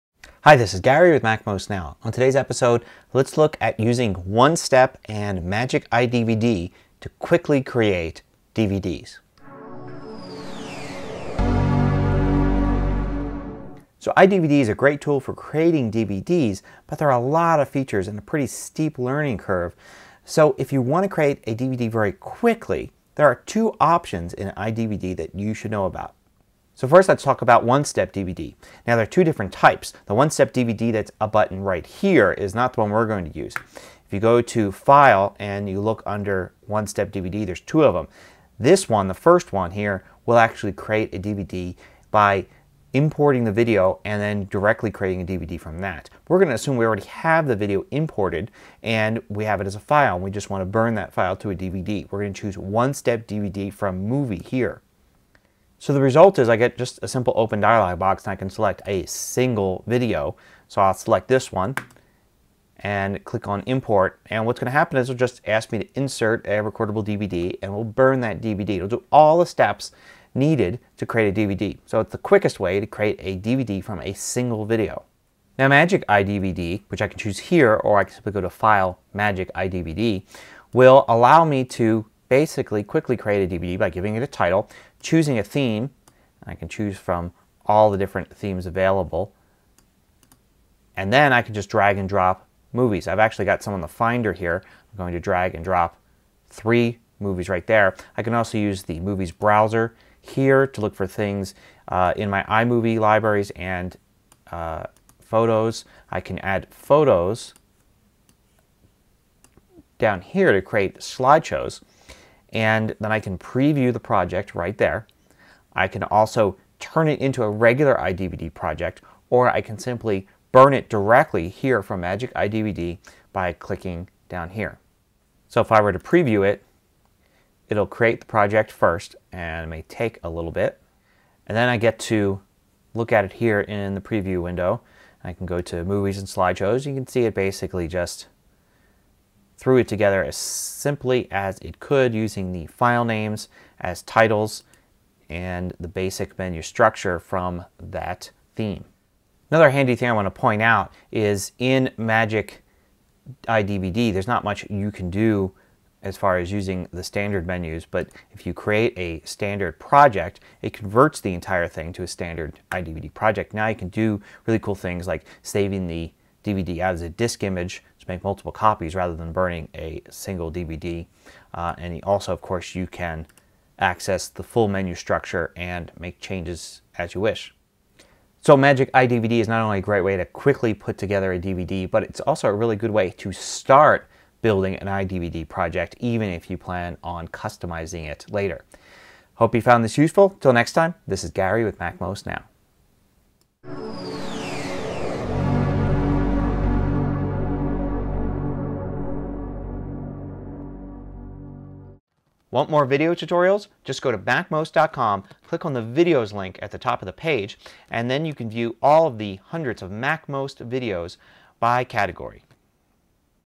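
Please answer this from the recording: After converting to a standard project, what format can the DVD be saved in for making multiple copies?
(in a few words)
A disk image.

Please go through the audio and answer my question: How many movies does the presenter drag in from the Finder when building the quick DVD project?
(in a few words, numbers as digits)
3.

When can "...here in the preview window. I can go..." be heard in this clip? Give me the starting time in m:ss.
2:13.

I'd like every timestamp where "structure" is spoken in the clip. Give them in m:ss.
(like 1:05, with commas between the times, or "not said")
2:26, 2:54.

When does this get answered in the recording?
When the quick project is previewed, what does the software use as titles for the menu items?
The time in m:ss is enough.
2:22.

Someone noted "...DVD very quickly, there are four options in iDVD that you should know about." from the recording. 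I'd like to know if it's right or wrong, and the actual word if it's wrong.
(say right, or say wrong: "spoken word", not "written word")
wrong: "two", not "four".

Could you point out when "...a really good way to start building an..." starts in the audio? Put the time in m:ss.
3:02.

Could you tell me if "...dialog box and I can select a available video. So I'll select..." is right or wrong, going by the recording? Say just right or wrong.
wrong.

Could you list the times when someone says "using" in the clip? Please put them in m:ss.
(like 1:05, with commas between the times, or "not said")
0:03, 2:22, 2:36.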